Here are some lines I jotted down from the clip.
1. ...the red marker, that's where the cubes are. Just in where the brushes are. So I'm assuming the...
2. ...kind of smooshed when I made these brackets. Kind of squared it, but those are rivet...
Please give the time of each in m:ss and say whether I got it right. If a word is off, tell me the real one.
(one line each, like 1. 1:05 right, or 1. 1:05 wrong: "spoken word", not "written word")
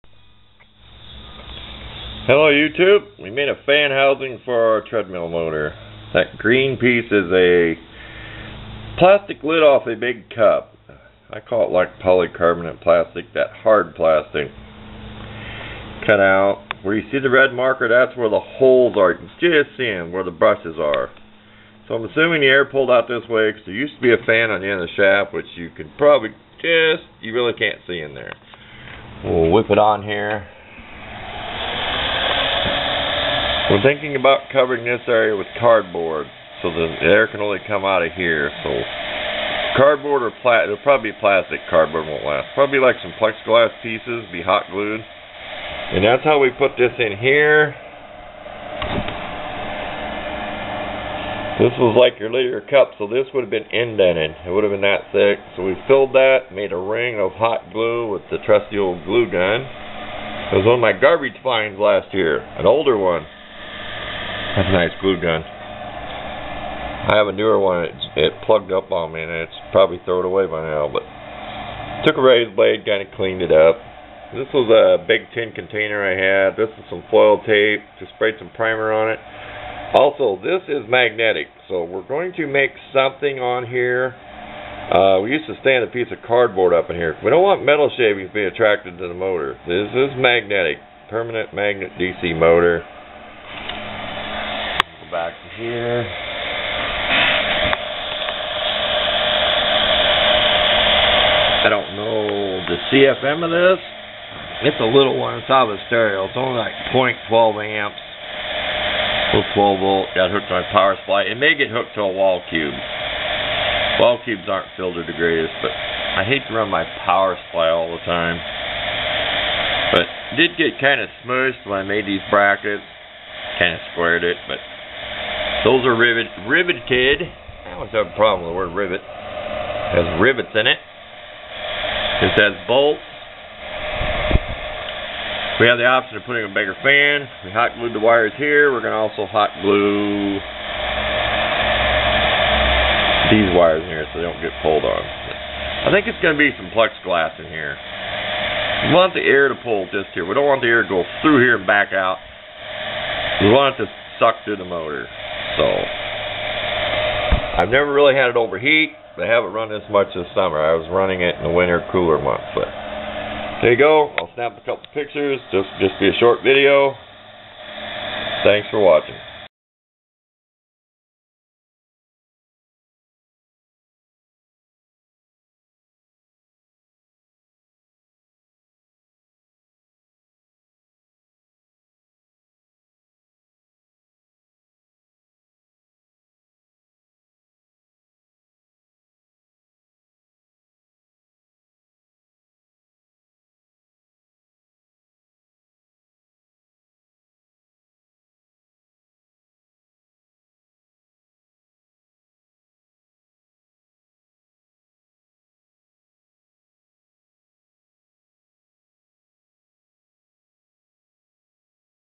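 1. 0:17 wrong: "holes", not "cubes"
2. 2:00 right.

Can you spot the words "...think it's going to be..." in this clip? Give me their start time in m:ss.
2:25.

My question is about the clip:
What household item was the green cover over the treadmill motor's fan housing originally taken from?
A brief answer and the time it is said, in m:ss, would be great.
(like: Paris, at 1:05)
lid off a big cup, at 0:08.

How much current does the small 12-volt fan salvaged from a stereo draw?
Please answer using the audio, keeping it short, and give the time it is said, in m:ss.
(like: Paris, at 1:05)
0.12 amps, at 1:46.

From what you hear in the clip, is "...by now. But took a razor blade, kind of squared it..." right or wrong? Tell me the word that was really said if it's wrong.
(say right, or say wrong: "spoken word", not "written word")
wrong: "cleaned", not "squared".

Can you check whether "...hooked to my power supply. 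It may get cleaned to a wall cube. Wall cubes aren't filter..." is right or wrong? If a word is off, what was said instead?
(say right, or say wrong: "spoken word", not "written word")
wrong: "hooked", not "cleaned".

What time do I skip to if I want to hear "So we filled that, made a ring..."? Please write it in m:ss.
0:55.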